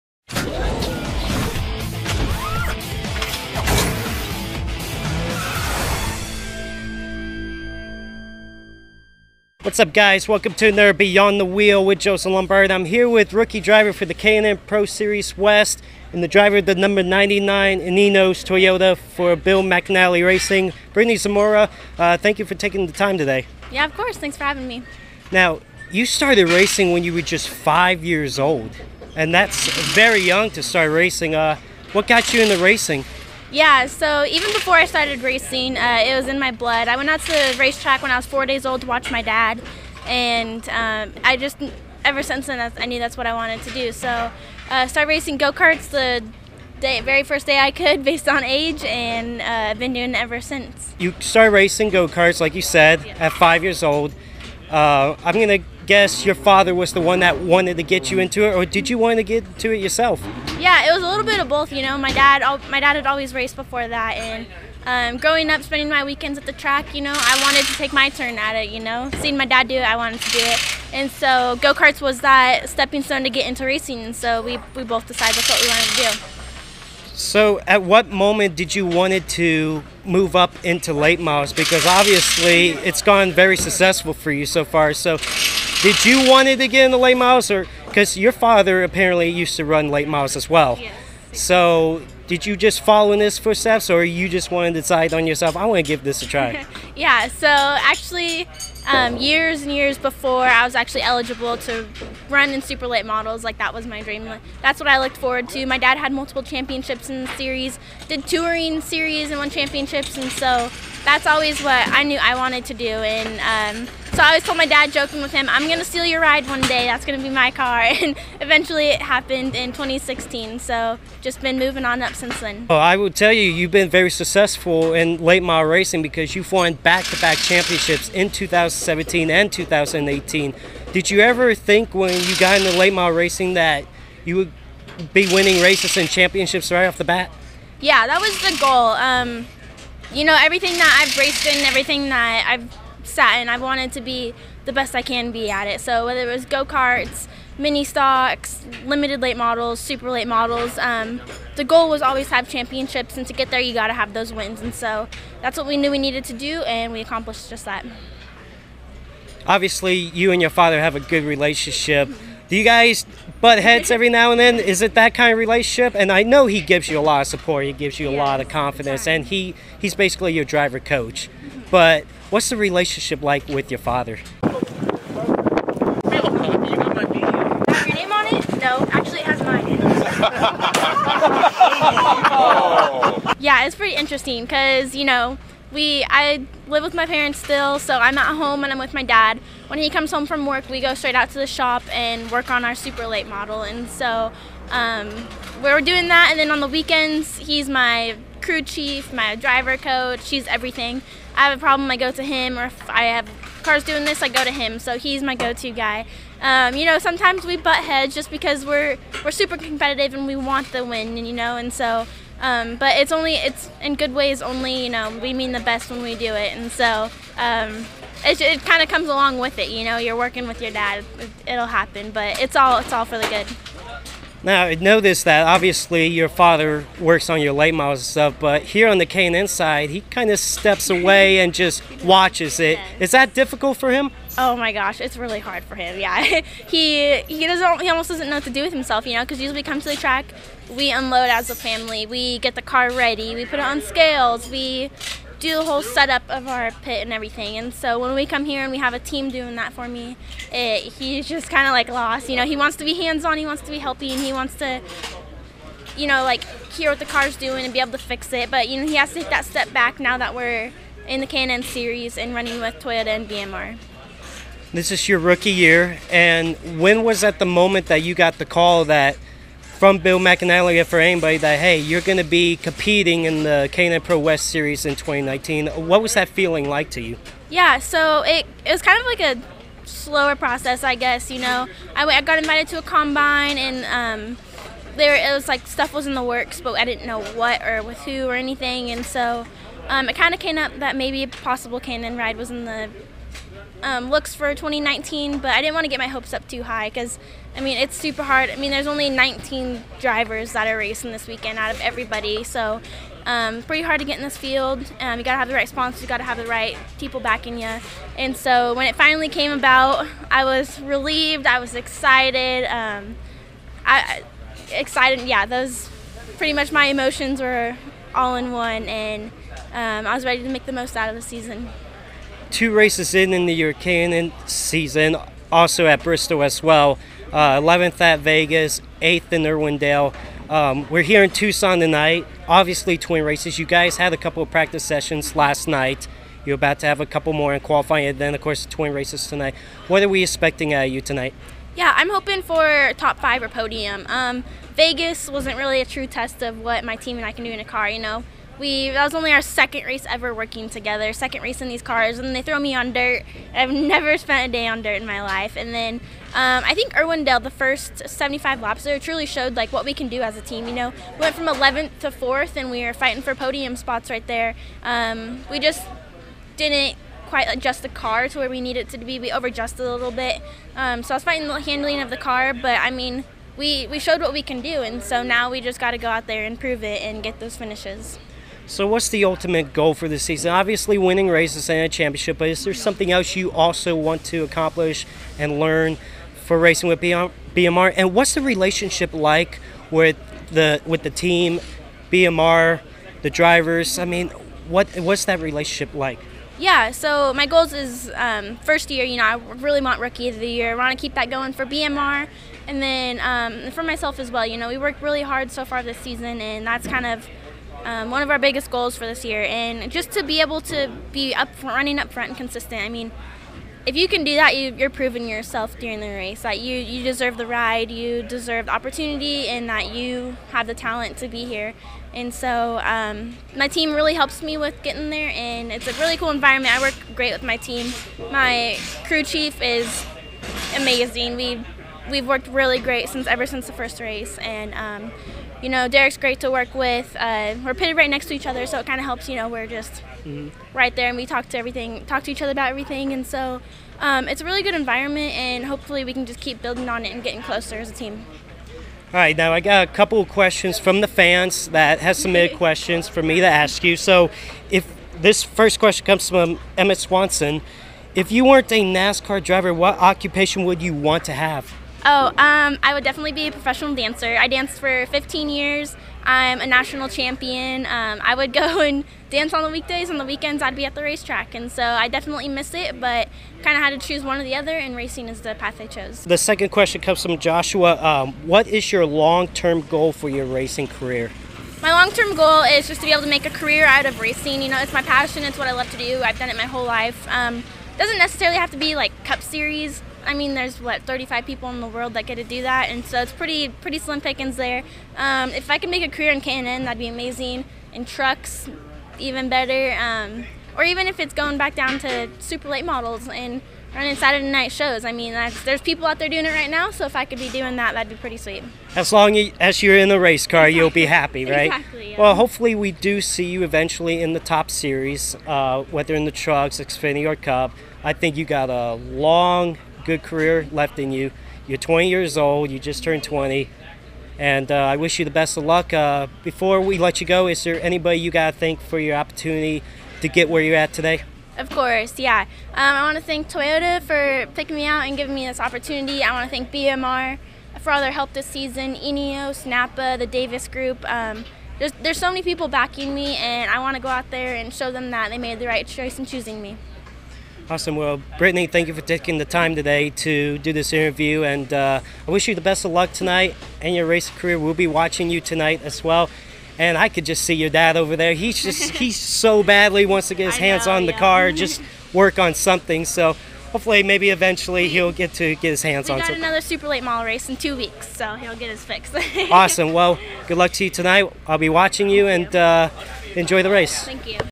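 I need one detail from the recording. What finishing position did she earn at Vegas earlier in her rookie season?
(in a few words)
11th.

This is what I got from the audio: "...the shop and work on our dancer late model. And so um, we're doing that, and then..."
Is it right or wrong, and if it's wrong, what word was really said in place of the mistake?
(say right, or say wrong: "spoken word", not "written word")
wrong: "super", not "dancer".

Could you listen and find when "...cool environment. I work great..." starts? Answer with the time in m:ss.
7:06.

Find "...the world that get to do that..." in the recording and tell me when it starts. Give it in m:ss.
8:11.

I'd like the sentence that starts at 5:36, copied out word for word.
You're about to have a couple more in qualifying, and then, of course, twin races tonight.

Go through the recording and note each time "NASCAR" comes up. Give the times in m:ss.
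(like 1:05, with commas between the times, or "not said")
7:38.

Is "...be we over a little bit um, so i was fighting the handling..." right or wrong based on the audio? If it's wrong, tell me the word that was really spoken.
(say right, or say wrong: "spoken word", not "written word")
right.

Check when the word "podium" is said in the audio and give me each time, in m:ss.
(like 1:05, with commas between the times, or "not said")
5:43, 6:03.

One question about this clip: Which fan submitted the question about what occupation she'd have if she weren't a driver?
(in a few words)
Emmett Swanson.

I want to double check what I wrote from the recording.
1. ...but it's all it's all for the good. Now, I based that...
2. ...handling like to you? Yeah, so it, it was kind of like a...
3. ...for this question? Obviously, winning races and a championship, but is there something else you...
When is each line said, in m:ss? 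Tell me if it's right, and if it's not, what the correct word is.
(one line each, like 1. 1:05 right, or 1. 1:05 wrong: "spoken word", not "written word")
1. 3:42 wrong: "noticed", not "based"
2. 4:36 wrong: "feeling", not "handling"
3. 6:19 wrong: "season", not "question".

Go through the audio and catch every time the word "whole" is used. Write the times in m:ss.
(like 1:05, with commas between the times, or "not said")
4:05, 8:06.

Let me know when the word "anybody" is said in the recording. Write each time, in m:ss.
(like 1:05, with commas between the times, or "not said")
4:30, 8:47.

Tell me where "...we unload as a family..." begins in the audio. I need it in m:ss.
4:00.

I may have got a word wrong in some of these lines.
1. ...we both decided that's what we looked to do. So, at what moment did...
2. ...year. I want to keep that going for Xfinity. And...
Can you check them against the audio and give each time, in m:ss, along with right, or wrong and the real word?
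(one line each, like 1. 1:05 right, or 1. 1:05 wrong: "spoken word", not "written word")
1. 1:14 wrong: "wanted", not "looked"
2. 6:40 wrong: "BMR", not "Xfinity".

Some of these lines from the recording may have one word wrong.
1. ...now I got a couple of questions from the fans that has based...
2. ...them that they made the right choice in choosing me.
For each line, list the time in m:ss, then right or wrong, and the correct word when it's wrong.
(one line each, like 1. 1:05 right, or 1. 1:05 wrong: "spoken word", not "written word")
1. 7:29 wrong: "submitted", not "based"
2. 9:04 right.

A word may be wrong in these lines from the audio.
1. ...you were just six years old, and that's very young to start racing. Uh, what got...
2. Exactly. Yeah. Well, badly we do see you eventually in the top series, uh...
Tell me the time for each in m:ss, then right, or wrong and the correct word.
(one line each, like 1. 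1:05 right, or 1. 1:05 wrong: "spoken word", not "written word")
1. 0:27 wrong: "five", not "six"
2. 8:31 wrong: "hopefully", not "badly".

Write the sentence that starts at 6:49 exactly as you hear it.
And just to be able to be up running up front and consistent.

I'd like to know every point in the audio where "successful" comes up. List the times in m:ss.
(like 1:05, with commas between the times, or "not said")
1:23, 2:04.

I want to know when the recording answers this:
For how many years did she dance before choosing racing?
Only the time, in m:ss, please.
7:45.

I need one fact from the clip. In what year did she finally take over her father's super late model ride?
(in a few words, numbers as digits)
2016.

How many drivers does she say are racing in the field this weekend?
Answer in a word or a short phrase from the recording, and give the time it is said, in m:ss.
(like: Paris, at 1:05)
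19, at 4:59.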